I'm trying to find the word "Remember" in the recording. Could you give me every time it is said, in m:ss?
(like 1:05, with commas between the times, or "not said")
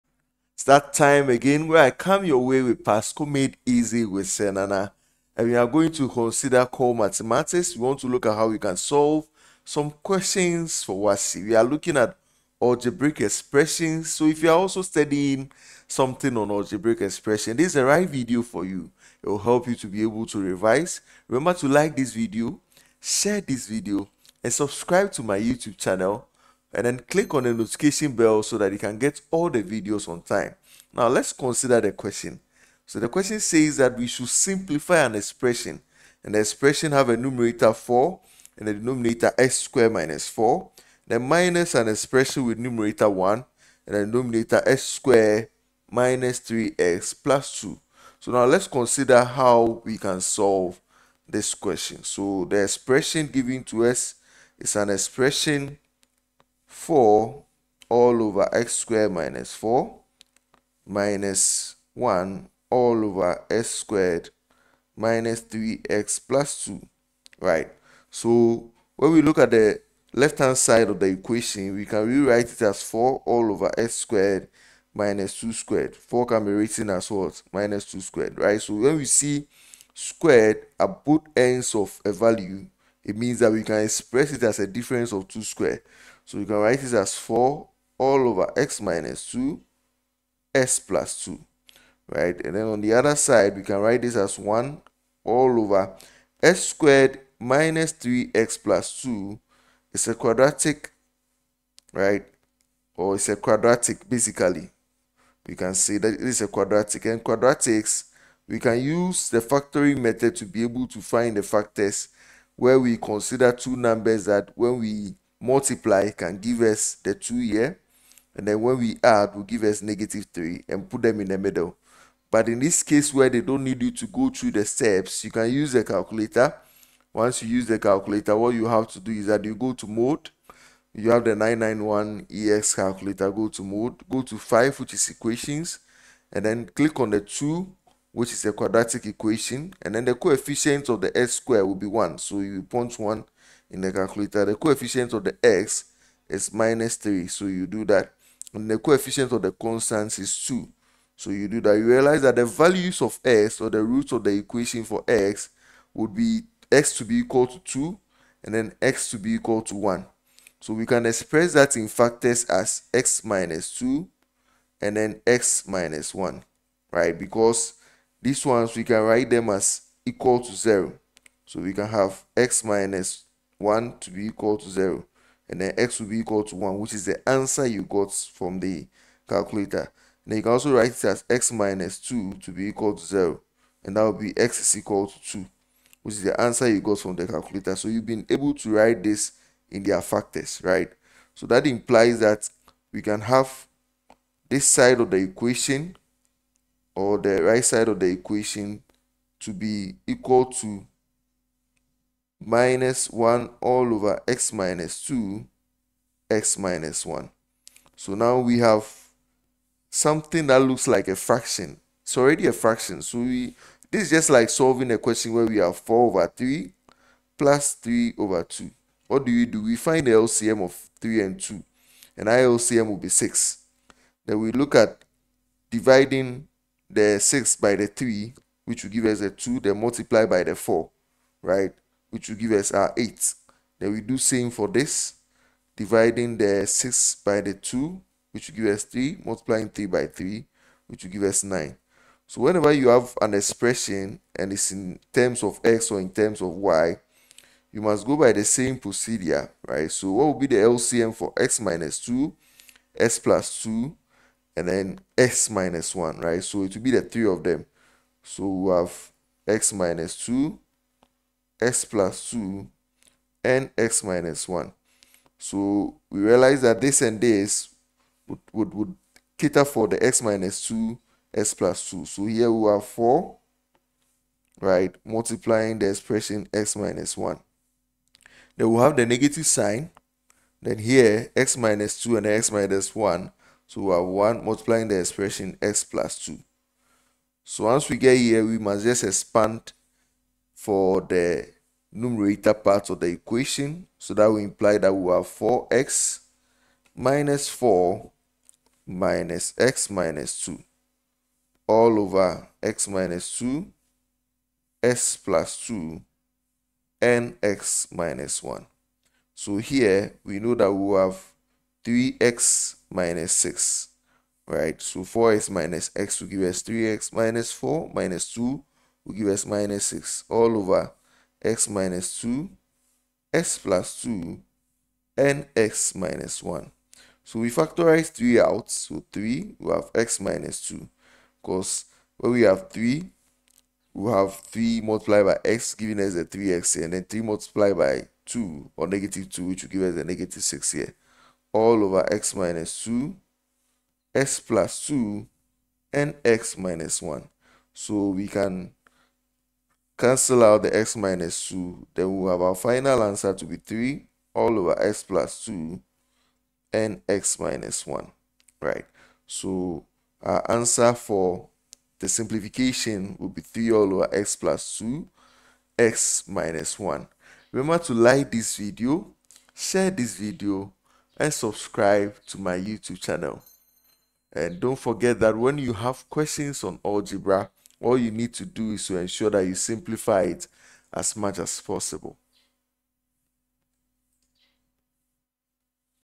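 0:21, 6:07.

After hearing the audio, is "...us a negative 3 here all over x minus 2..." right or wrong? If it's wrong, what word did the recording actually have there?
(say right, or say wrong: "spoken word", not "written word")
wrong: "6", not "3".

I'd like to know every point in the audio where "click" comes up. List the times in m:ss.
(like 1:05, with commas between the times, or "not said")
0:26, 2:16.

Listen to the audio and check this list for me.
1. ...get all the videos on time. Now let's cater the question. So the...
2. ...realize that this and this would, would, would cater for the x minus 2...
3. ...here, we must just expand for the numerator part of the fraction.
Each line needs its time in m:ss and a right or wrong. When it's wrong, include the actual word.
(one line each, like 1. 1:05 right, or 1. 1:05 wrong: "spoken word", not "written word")
1. 0:28 wrong: "consider", not "cater"
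2. 4:26 right
3. 4:48 wrong: "equation", not "fraction".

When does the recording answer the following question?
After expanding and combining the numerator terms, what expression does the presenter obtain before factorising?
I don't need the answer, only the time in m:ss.
5:11.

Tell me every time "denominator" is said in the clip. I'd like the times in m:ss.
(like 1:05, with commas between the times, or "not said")
0:38, 0:44.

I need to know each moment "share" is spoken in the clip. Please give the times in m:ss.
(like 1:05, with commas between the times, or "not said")
0:23, 6:09.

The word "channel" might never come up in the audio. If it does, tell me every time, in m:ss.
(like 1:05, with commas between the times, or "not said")
0:25, 6:12.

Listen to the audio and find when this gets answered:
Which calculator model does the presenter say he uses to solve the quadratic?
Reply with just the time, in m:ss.
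2:11.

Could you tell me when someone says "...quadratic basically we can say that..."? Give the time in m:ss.
1:43.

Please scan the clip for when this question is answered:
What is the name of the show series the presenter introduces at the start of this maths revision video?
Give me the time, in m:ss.
0:02.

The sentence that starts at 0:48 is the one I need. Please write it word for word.
So now let's consider how we can solve this question.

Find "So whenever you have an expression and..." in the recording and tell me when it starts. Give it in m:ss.
4:02.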